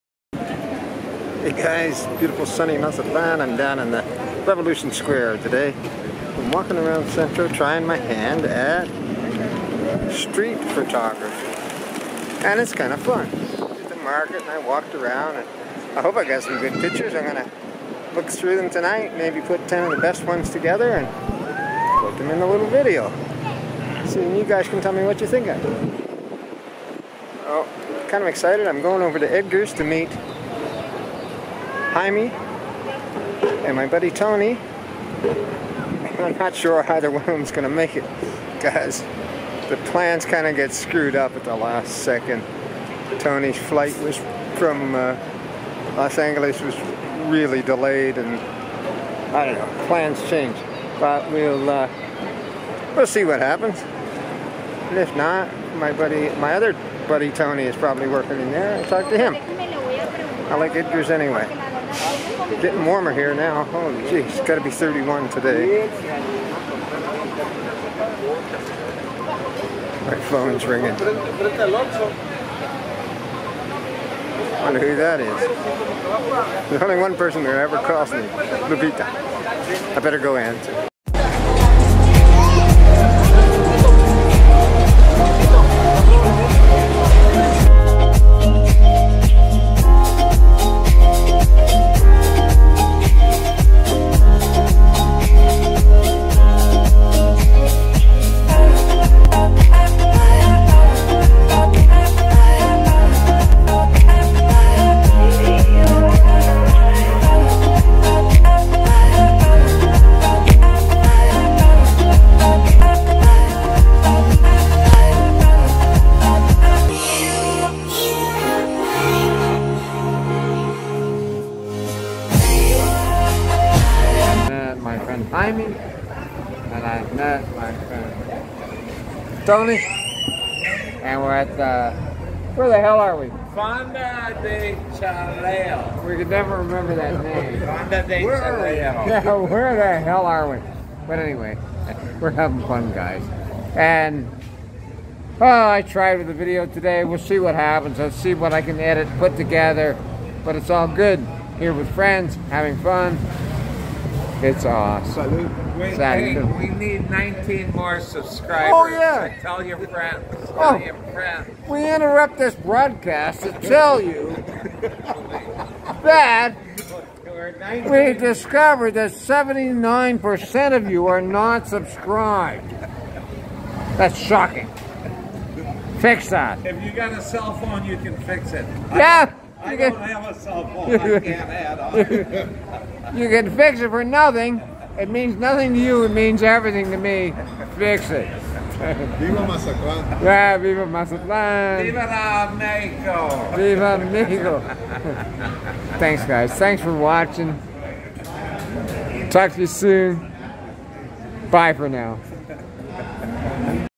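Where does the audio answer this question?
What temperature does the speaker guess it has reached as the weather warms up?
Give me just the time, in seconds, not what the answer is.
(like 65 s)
64 s.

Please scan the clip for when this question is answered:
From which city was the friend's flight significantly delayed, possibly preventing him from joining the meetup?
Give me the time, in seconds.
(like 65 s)
45 s.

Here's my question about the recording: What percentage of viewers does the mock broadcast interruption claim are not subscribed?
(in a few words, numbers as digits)
79%.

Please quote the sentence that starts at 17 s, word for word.
I'm gonna look through them tonight, maybe put 10 of the best ones together and put them in a little video.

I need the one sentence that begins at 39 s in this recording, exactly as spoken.
The plans kind of get screwed up at the last second.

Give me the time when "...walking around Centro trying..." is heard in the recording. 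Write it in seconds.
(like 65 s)
6 s.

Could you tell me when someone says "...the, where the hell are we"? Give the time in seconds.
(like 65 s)
131 s.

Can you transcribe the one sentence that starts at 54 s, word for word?
And if not, my buddy, my other buddy Tony is probably working in there.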